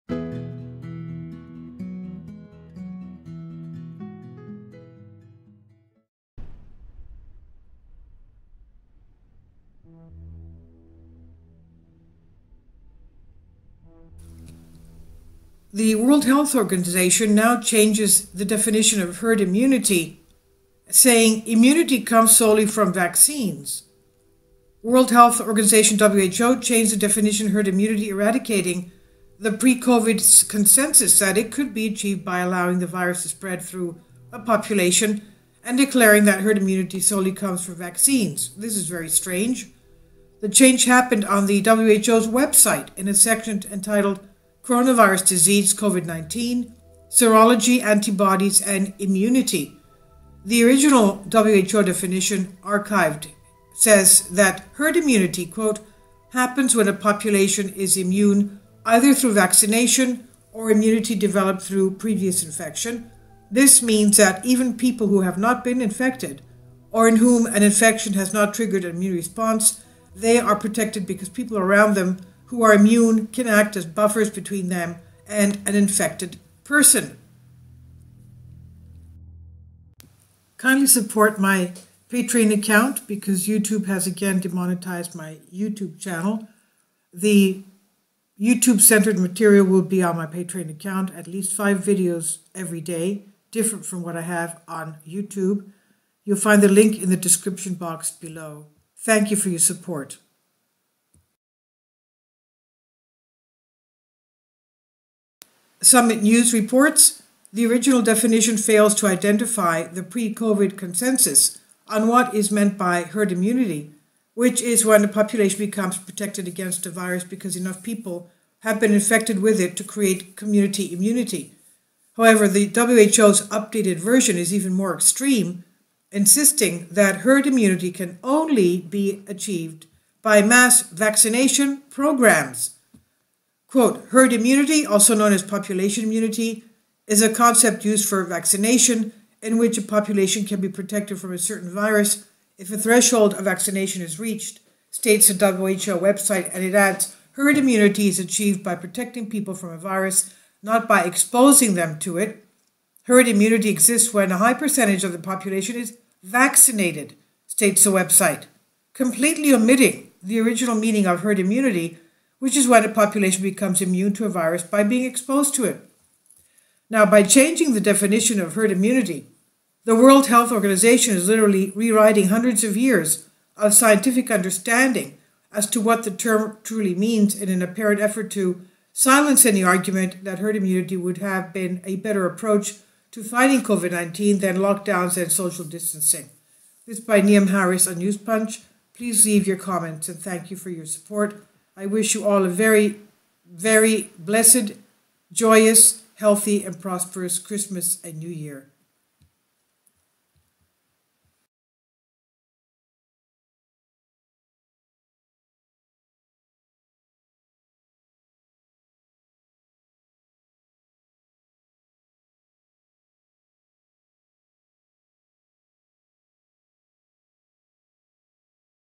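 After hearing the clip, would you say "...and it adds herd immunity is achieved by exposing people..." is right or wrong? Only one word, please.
wrong.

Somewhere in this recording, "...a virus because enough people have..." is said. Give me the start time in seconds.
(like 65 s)
116 s.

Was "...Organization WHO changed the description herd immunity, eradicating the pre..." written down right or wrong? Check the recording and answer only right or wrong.
wrong.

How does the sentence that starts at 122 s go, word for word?
However, the WHO's updated version is even more extreme insisting that herd immunity can only be achieved by mass vaccination programs.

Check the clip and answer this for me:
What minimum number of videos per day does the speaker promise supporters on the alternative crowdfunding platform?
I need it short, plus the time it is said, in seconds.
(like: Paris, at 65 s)
5, at 91 s.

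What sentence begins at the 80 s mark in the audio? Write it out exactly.
Kindly support my Patreon account because YouTube has again demonetized my YouTube channel.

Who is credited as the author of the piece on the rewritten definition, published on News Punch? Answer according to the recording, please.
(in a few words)
Niamh Harris.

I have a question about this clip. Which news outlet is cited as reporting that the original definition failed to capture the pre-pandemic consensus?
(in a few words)
Summit News.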